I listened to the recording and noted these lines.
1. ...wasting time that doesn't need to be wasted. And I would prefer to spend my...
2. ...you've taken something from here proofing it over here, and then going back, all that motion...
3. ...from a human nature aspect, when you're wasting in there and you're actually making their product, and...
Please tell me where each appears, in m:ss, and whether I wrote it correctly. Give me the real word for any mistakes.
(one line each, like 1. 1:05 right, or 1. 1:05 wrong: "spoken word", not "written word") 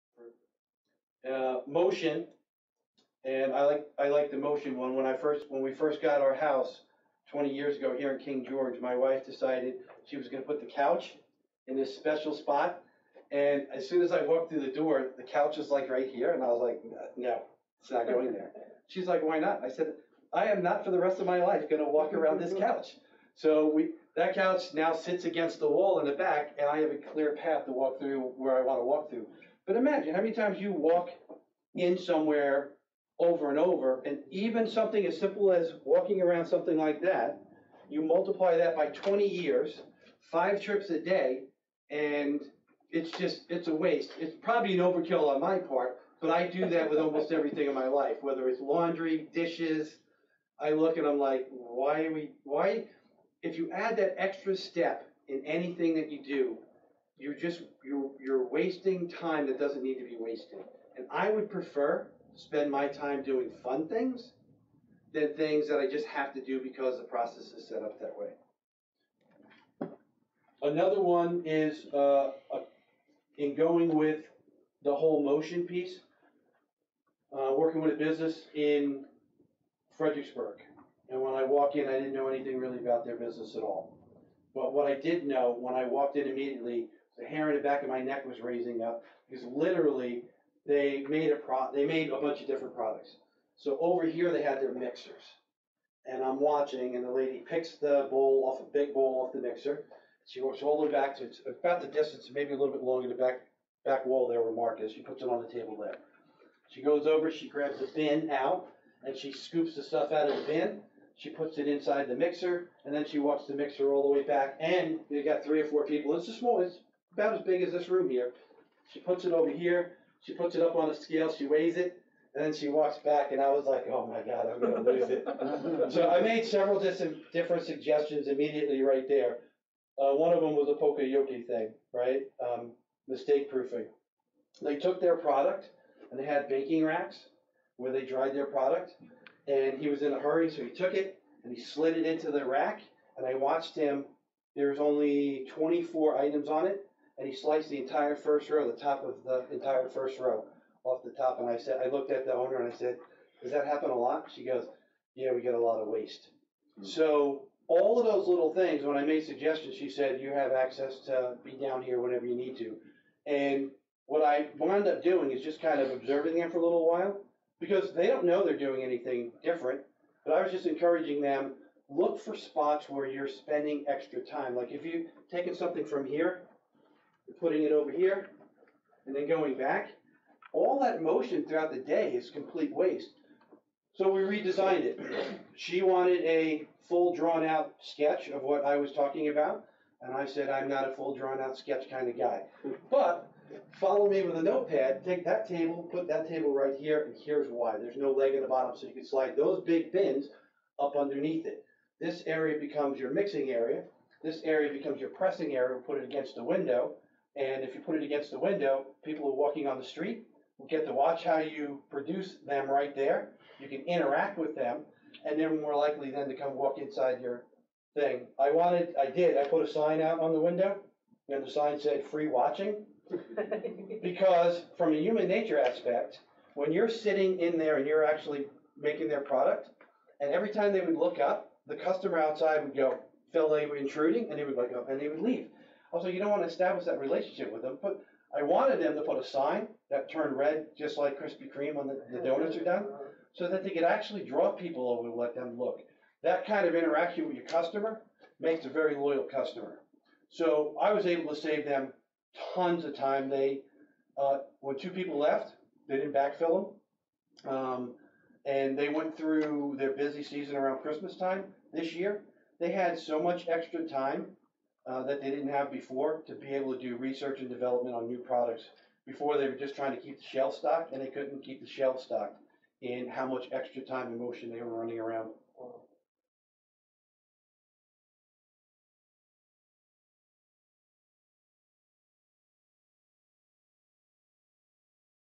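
1. 0:58 right
2. 2:54 wrong: "putting", not "proofing"
3. 3:44 wrong: "sitting", not "wasting".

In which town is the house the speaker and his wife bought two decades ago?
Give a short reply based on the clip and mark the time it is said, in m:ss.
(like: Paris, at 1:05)
King George, at 0:08.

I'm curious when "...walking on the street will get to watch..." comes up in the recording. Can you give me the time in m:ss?
3:29.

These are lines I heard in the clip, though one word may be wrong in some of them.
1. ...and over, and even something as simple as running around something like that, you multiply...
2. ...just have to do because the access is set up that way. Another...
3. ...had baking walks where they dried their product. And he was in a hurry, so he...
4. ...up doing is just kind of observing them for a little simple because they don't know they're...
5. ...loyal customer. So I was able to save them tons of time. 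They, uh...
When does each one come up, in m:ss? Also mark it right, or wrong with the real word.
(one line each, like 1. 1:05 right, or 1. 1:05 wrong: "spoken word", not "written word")
1. 0:33 wrong: "walking", not "running"
2. 1:05 wrong: "process", not "access"
3. 2:16 wrong: "racks", not "walks"
4. 2:44 wrong: "while", not "simple"
5. 4:08 right.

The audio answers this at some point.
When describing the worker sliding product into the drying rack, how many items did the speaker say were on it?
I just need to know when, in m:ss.
2:25.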